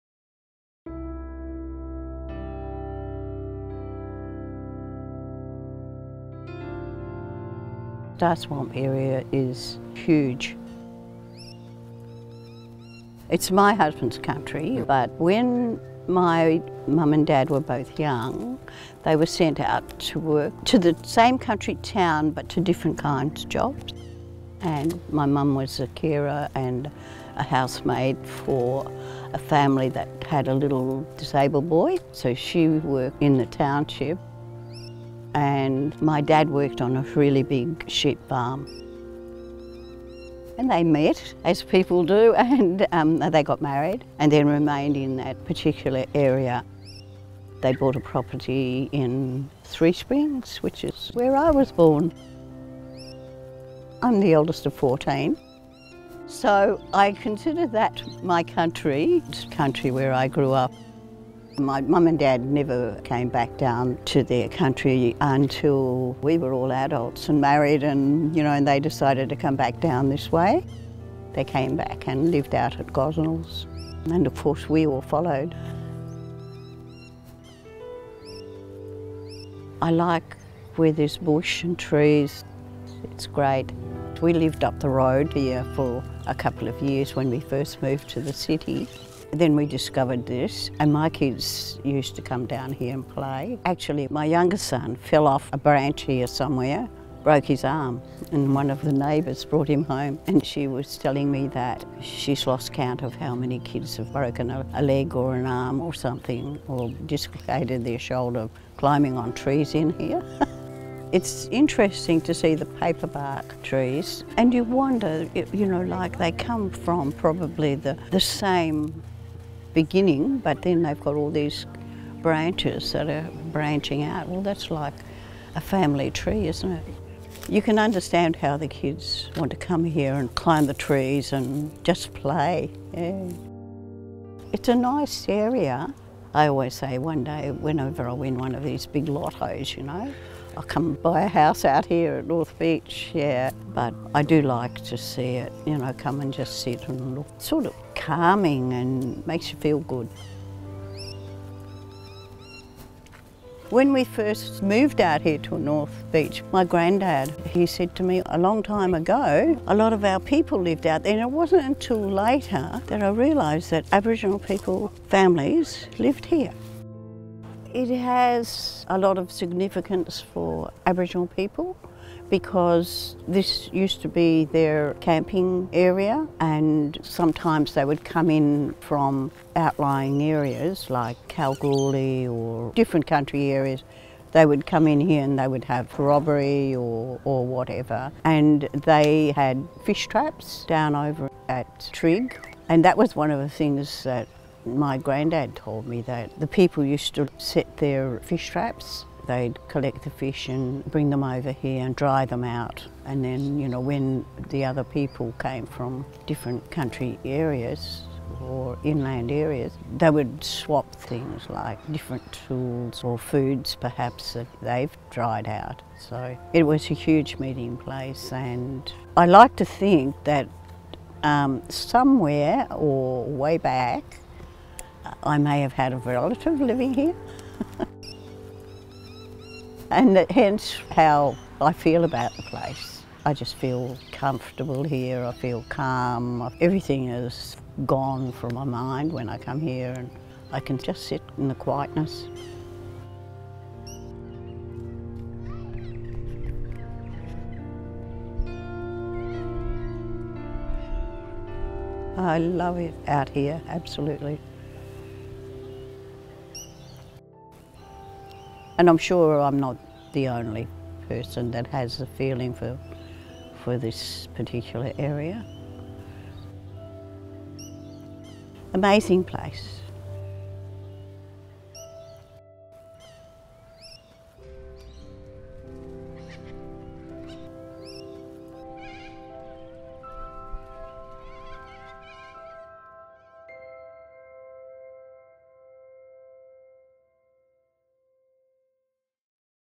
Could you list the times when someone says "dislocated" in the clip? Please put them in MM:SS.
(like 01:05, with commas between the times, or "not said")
01:47.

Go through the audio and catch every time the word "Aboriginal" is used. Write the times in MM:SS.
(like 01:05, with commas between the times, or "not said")
02:43, 02:50.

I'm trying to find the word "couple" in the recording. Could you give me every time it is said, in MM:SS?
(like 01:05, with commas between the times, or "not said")
01:26.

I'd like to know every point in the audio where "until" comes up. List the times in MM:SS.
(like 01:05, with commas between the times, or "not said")
01:05, 02:41.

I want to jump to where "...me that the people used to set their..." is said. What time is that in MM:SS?
03:15.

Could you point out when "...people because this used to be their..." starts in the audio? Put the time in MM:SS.
02:51.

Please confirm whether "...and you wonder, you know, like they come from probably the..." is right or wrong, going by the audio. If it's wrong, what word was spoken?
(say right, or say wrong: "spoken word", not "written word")
right.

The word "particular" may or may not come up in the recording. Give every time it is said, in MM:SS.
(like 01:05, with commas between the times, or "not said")
00:45, 04:24.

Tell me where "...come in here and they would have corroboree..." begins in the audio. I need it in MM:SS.
03:04.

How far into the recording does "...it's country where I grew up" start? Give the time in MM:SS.
00:59.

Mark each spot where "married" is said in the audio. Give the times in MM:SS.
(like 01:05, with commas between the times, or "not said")
00:43, 01:07.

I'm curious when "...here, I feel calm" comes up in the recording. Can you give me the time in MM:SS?
03:54.